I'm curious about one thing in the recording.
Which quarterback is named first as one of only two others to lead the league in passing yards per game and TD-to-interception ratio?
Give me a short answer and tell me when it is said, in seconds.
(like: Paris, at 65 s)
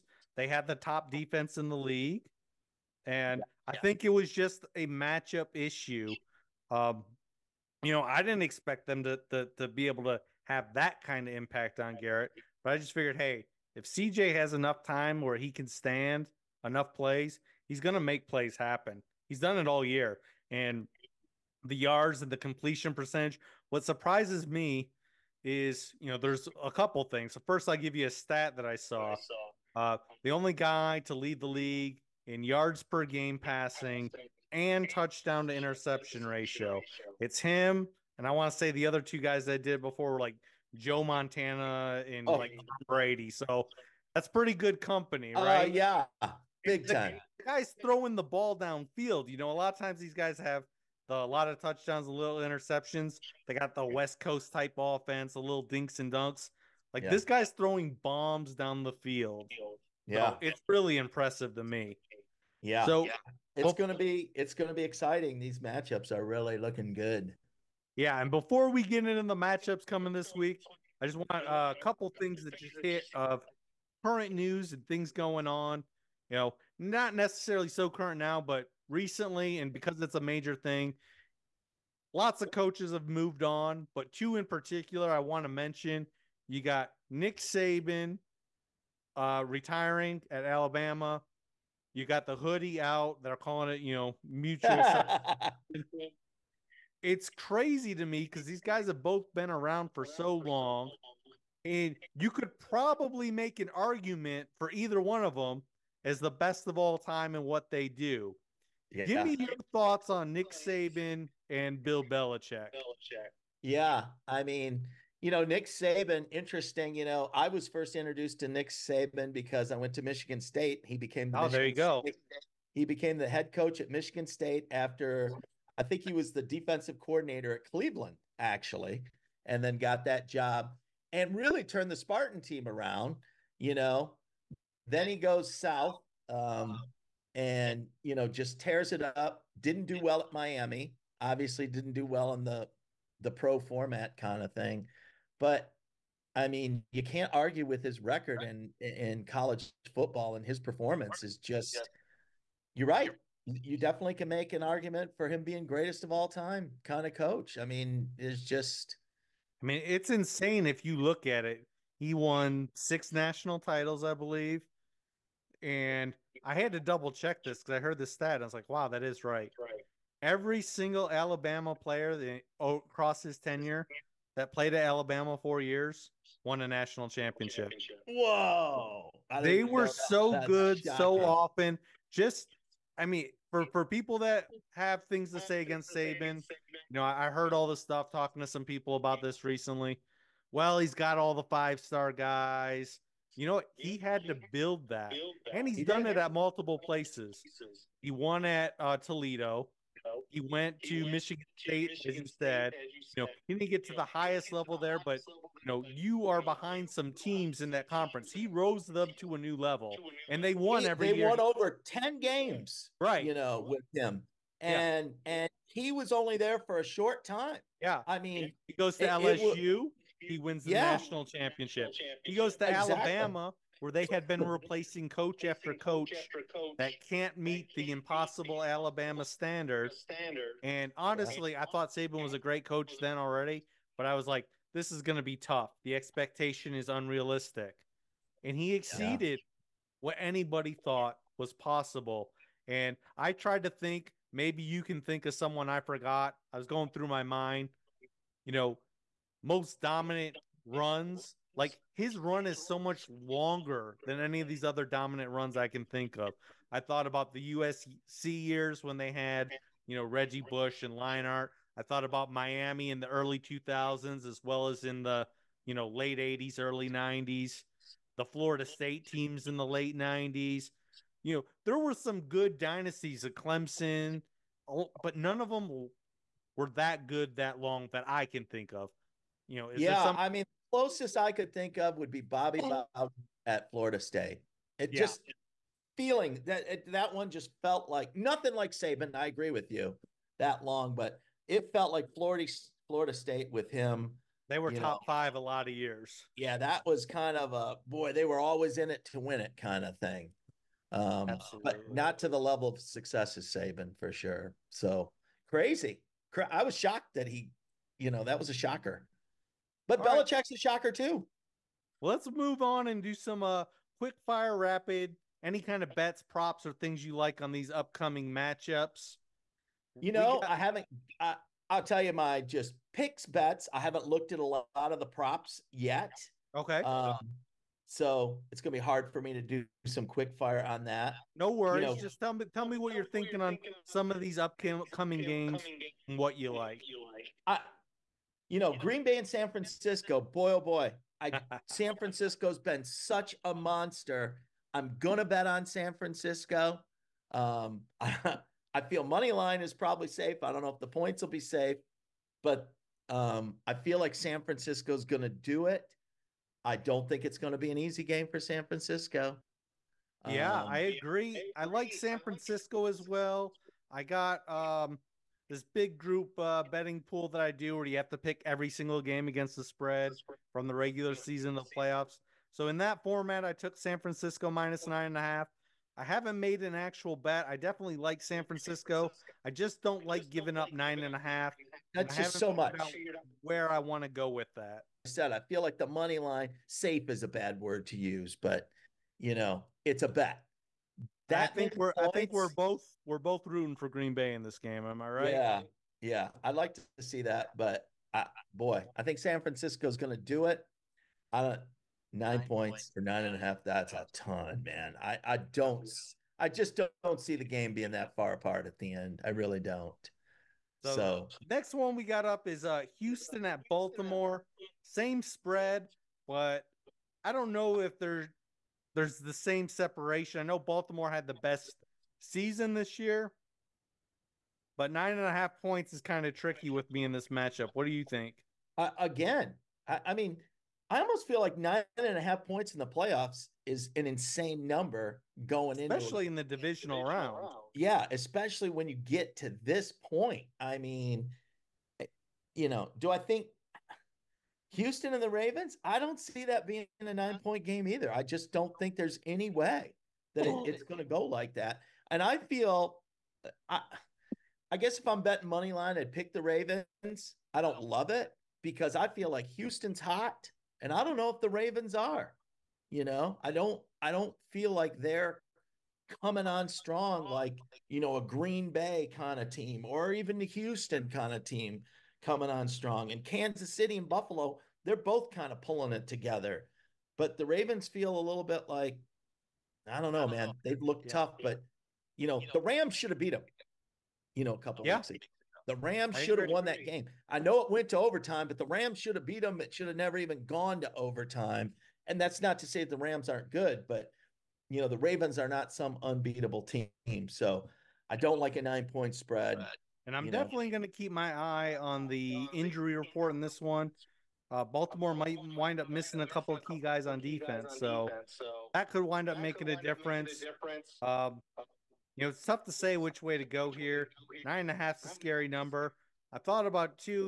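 Joe Montana, at 40 s.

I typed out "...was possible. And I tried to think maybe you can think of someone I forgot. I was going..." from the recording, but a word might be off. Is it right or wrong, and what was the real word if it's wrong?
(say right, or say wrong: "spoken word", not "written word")
right.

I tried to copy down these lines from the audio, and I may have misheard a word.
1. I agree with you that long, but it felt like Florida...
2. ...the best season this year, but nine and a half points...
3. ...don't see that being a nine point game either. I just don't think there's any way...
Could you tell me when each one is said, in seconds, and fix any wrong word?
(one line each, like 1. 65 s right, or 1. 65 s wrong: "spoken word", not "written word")
1. 289 s right
2. 421 s right
3. 445 s right.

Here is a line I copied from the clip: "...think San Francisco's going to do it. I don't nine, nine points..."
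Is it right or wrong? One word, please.
right.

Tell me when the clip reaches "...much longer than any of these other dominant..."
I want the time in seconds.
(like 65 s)
252 s.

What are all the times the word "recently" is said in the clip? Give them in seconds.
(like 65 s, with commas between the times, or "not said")
78 s, 189 s.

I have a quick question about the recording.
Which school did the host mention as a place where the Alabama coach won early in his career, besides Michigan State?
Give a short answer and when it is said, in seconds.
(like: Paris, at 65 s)
Toledo, at 198 s.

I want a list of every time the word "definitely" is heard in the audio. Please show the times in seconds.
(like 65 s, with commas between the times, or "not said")
153 s, 377 s, 500 s.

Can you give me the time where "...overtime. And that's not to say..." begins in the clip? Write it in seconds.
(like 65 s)
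490 s.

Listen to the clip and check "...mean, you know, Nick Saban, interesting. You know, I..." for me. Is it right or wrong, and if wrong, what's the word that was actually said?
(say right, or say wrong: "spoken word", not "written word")
right.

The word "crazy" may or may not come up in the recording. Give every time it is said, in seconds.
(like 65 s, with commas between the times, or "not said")
97 s, 305 s.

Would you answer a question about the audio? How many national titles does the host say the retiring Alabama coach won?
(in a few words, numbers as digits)
6.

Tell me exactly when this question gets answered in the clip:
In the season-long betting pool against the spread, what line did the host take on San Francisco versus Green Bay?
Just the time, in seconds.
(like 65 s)
374 s.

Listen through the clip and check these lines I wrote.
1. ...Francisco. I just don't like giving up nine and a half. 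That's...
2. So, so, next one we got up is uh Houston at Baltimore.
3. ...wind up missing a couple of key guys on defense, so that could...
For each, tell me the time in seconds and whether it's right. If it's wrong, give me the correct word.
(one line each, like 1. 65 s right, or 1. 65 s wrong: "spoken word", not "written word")
1. 378 s right
2. 410 s right
3. 505 s right.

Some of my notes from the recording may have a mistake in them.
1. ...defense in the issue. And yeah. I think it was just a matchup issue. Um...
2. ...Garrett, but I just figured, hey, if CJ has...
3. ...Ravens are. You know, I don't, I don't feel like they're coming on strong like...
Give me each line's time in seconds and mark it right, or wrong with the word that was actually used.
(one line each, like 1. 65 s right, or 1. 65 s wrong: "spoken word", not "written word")
1. 1 s wrong: "league", not "issue"
2. 12 s right
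3. 461 s right.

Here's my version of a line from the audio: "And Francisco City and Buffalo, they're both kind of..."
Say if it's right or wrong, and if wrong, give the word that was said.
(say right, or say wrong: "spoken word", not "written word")
wrong: "Kansas", not "Francisco".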